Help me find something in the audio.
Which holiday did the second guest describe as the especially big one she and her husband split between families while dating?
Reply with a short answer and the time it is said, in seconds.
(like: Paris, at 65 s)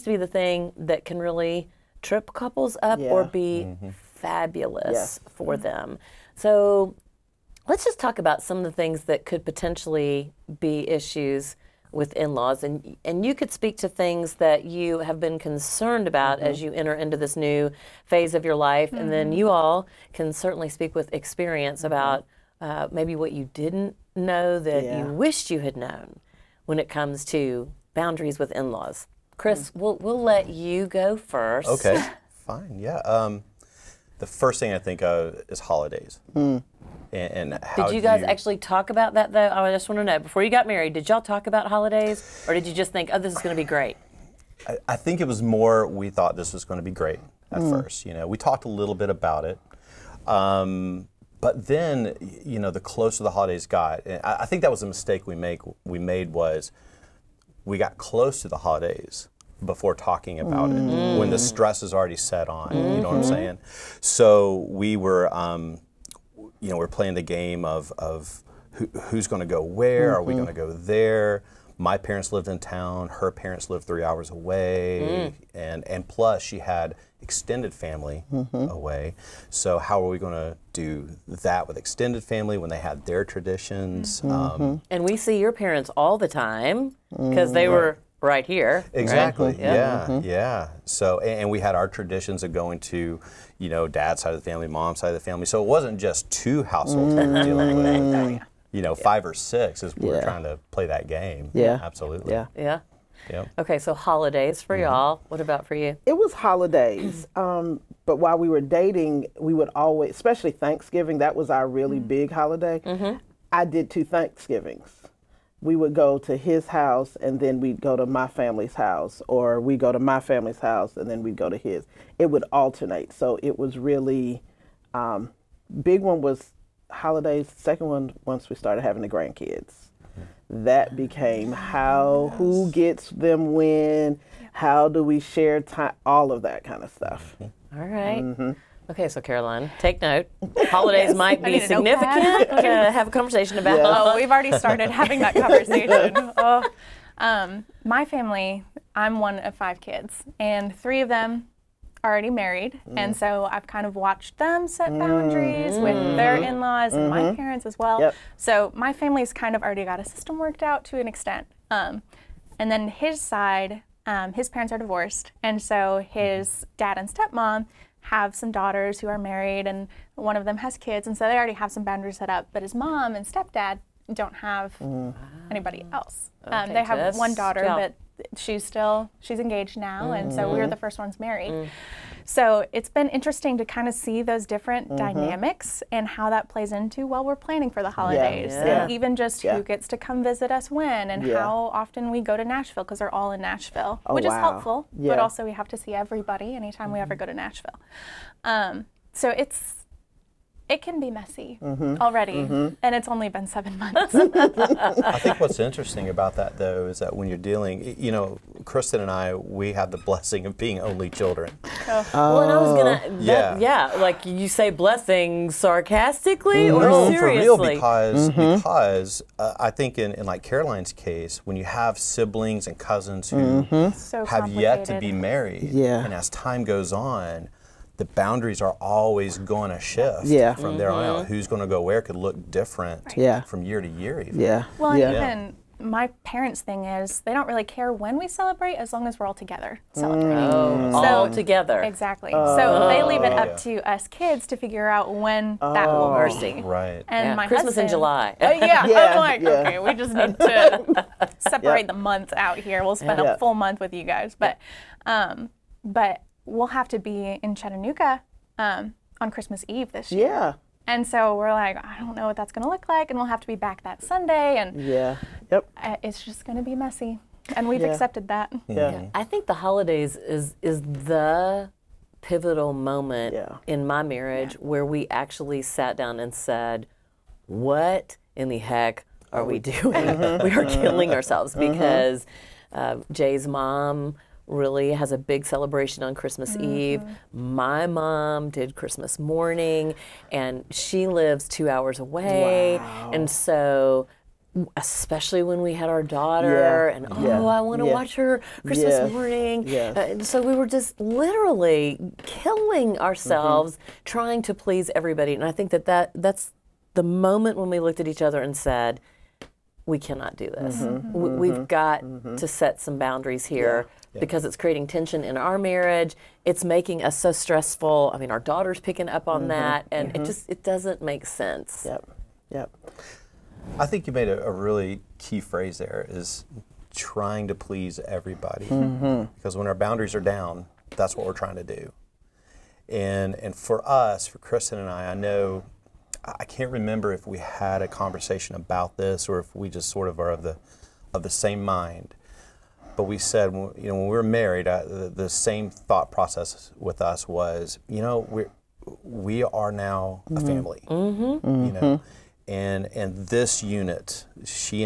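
Thanksgiving, at 110 s.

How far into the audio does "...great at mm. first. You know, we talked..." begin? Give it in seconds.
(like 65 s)
46 s.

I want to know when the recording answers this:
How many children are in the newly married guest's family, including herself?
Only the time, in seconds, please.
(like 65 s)
149 s.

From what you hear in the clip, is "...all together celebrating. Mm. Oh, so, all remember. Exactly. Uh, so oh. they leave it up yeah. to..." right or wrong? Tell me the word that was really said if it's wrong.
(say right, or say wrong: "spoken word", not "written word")
wrong: "together", not "remember".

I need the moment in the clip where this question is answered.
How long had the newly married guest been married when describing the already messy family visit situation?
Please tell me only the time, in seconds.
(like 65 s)
203 s.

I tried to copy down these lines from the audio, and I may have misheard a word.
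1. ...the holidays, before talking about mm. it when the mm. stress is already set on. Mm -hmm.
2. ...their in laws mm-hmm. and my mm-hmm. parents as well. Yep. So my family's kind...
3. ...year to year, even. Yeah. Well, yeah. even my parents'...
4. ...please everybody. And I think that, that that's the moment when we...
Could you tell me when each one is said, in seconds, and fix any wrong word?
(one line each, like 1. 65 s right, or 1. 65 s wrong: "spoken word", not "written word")
1. 58 s right
2. 156 s right
3. 233 s right
4. 304 s right.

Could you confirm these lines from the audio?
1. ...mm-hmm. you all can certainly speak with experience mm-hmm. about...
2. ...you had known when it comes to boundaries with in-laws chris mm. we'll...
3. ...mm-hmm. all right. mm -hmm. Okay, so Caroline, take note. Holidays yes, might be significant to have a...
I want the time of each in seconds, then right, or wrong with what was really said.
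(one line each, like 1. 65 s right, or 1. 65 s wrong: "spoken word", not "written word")
1. 19 s right
2. 25 s right
3. 137 s right.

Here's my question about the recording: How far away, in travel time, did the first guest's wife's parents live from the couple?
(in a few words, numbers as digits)
3 hours.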